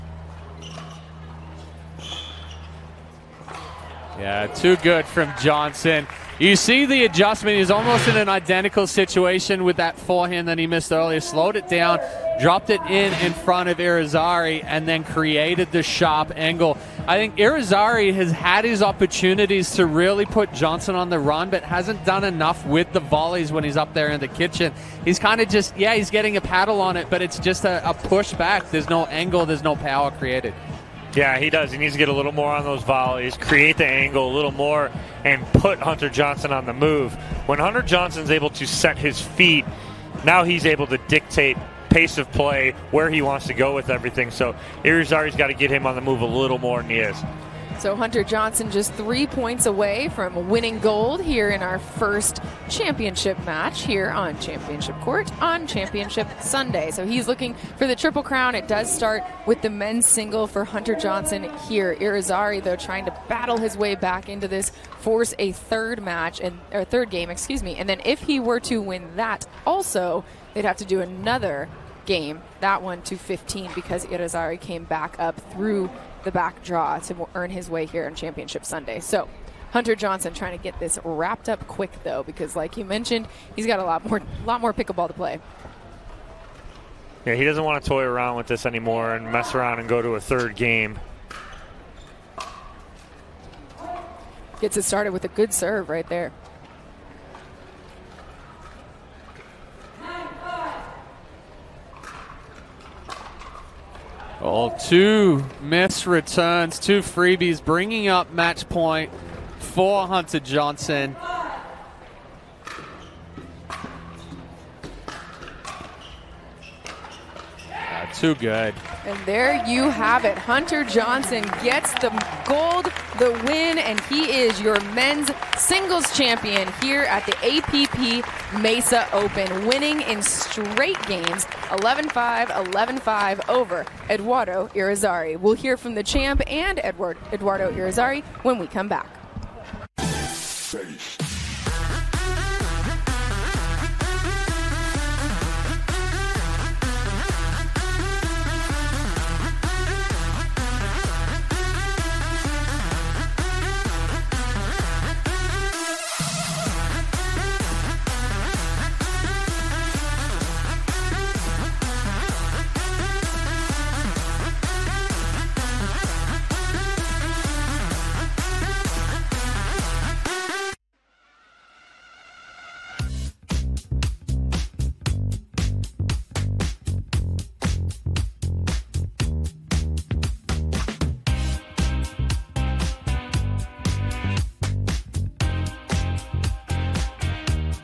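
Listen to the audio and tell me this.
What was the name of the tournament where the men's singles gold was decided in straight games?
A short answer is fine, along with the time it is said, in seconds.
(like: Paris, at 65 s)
APP Mesa Open, at 127 s.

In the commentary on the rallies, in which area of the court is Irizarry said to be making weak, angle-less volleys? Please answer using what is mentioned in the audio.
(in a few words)
The kitchen.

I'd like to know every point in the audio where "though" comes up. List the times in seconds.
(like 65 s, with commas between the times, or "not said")
62 s, 82 s.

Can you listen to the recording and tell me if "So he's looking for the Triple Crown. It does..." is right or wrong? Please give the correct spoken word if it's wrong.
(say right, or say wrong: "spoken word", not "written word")
right.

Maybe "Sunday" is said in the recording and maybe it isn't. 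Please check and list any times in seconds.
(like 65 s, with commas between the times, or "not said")
56 s, 78 s.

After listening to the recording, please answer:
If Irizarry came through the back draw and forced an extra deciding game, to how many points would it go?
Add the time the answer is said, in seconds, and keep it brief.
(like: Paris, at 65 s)
15, at 73 s.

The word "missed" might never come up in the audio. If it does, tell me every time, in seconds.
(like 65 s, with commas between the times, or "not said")
10 s, 105 s.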